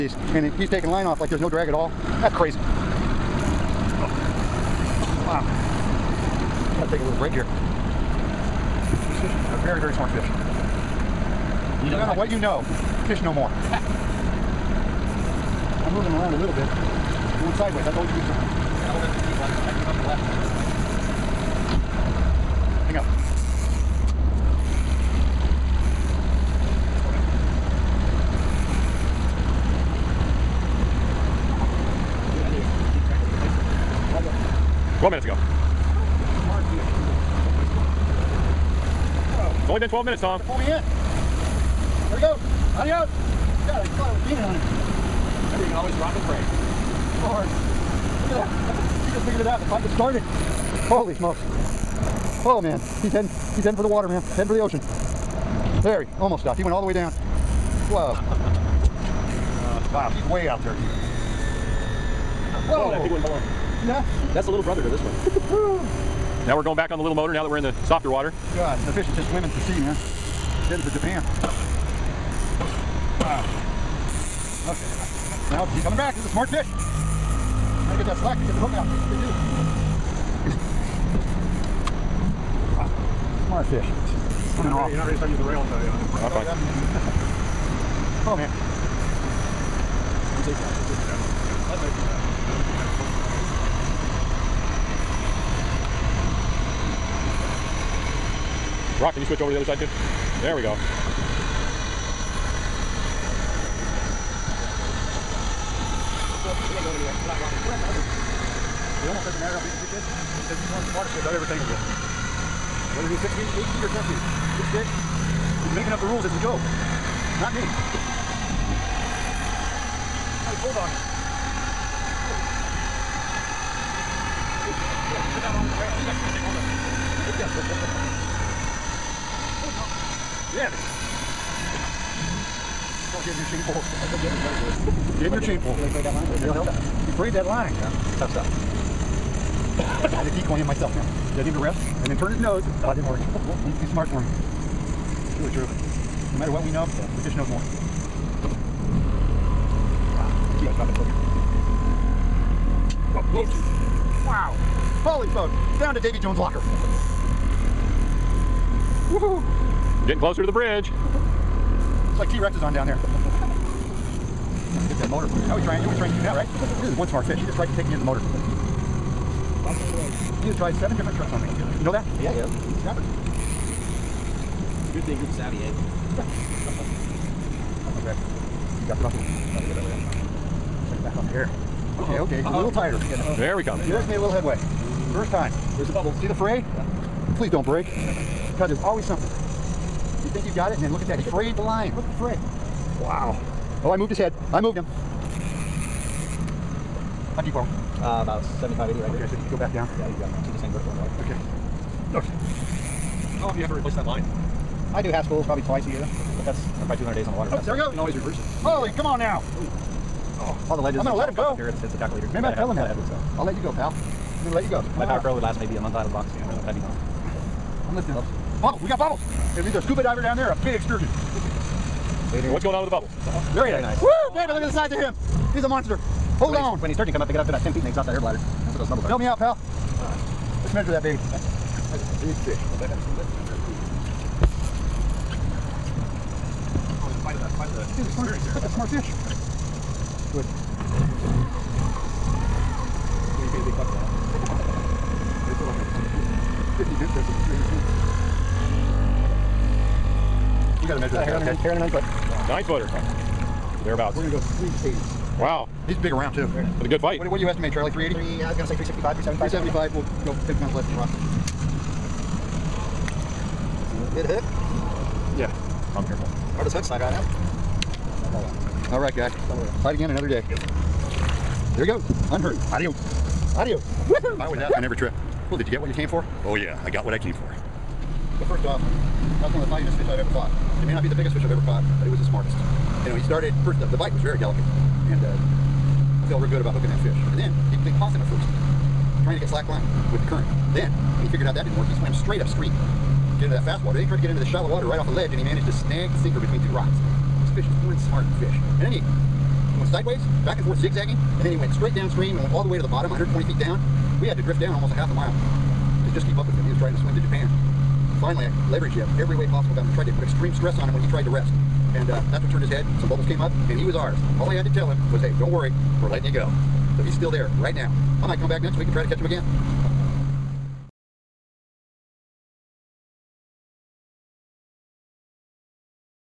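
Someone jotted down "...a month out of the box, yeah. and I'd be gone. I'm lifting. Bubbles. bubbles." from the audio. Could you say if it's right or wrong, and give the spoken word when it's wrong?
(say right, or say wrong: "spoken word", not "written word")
right.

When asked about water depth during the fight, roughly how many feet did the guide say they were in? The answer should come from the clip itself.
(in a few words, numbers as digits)
75 to 80.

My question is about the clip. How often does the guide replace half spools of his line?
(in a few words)
Twice a year.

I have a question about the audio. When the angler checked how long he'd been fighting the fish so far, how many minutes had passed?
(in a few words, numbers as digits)
12.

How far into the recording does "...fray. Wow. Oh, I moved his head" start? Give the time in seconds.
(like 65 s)
192 s.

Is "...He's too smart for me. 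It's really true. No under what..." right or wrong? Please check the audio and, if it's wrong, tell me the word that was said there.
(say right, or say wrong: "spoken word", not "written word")
wrong: "matter", not "under".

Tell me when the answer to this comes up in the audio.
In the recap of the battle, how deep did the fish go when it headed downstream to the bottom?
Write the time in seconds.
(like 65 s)
303 s.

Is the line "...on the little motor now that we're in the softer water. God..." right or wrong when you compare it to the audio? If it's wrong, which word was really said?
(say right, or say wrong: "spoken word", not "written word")
right.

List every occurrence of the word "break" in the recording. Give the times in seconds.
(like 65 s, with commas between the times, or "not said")
7 s, 187 s.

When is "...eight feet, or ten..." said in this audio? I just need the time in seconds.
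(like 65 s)
113 s.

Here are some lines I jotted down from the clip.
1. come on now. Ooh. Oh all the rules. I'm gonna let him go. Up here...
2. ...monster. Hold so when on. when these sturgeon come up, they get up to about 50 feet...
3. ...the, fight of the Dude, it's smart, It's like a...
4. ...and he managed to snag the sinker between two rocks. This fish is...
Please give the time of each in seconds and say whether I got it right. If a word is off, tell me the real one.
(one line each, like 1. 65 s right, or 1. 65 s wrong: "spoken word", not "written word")
1. 208 s wrong: "ledges", not "rules"
2. 225 s wrong: "10", not "50"
3. 237 s right
4. 295 s right.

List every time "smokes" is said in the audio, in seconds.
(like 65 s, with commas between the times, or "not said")
51 s, 155 s.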